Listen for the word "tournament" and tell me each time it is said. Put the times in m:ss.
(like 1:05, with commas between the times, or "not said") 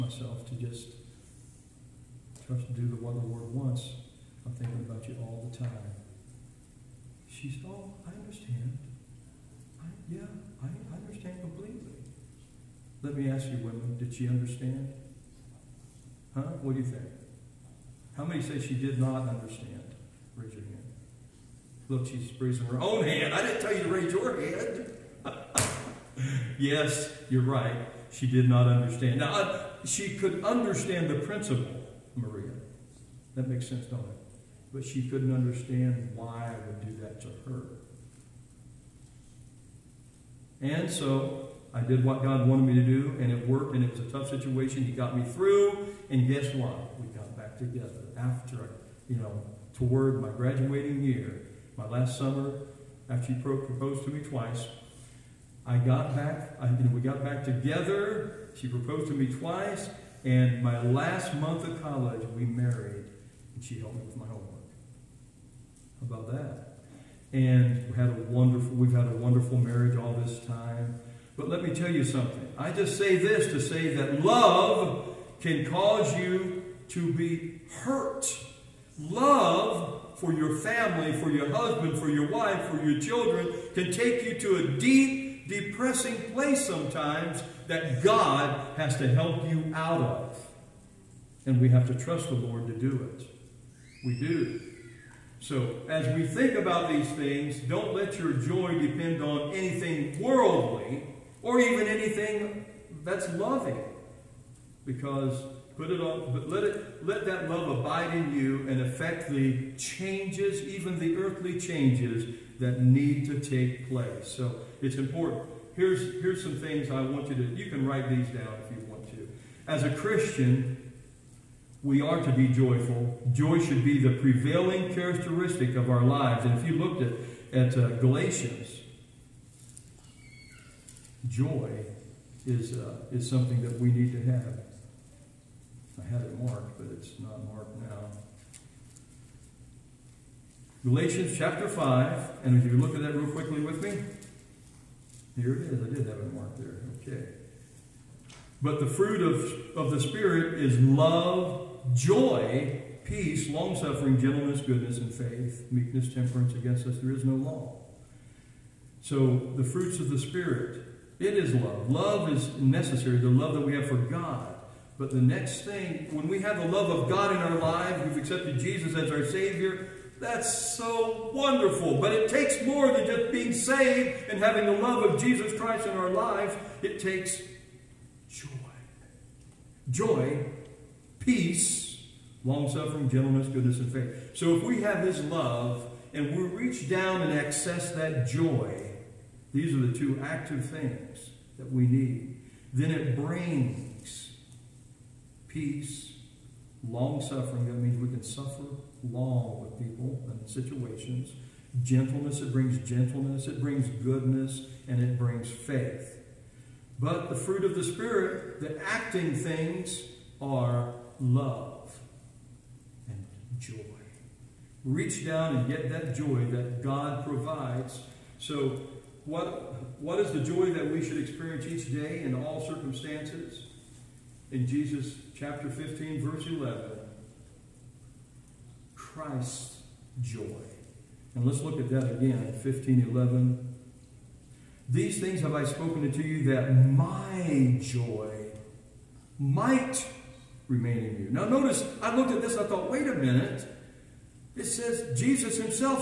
not said.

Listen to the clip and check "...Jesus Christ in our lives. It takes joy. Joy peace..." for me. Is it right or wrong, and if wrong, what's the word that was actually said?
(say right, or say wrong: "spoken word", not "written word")
right.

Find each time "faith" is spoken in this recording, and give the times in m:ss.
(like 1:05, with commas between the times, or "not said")
2:35, 3:03, 3:25.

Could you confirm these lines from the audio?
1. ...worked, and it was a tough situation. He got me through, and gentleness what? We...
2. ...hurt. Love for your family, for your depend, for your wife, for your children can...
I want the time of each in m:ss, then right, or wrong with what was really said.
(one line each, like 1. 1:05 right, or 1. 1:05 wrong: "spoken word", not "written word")
1. 0:43 wrong: "guess", not "gentleness"
2. 1:17 wrong: "husband", not "depend".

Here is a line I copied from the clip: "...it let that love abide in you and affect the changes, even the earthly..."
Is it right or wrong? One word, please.
right.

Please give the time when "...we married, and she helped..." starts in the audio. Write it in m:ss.
1:02.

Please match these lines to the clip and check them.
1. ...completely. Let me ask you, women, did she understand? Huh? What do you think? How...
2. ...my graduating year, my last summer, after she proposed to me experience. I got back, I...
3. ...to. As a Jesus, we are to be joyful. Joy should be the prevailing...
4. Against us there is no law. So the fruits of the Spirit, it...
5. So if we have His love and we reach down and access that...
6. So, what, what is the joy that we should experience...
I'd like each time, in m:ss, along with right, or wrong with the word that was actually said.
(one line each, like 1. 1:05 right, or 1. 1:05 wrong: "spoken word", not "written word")
1. 0:11 right
2. 0:50 wrong: "twice", not "experience"
3. 1:59 wrong: "Christian", not "Jesus"
4. 2:36 right
5. 3:04 right
6. 3:38 right.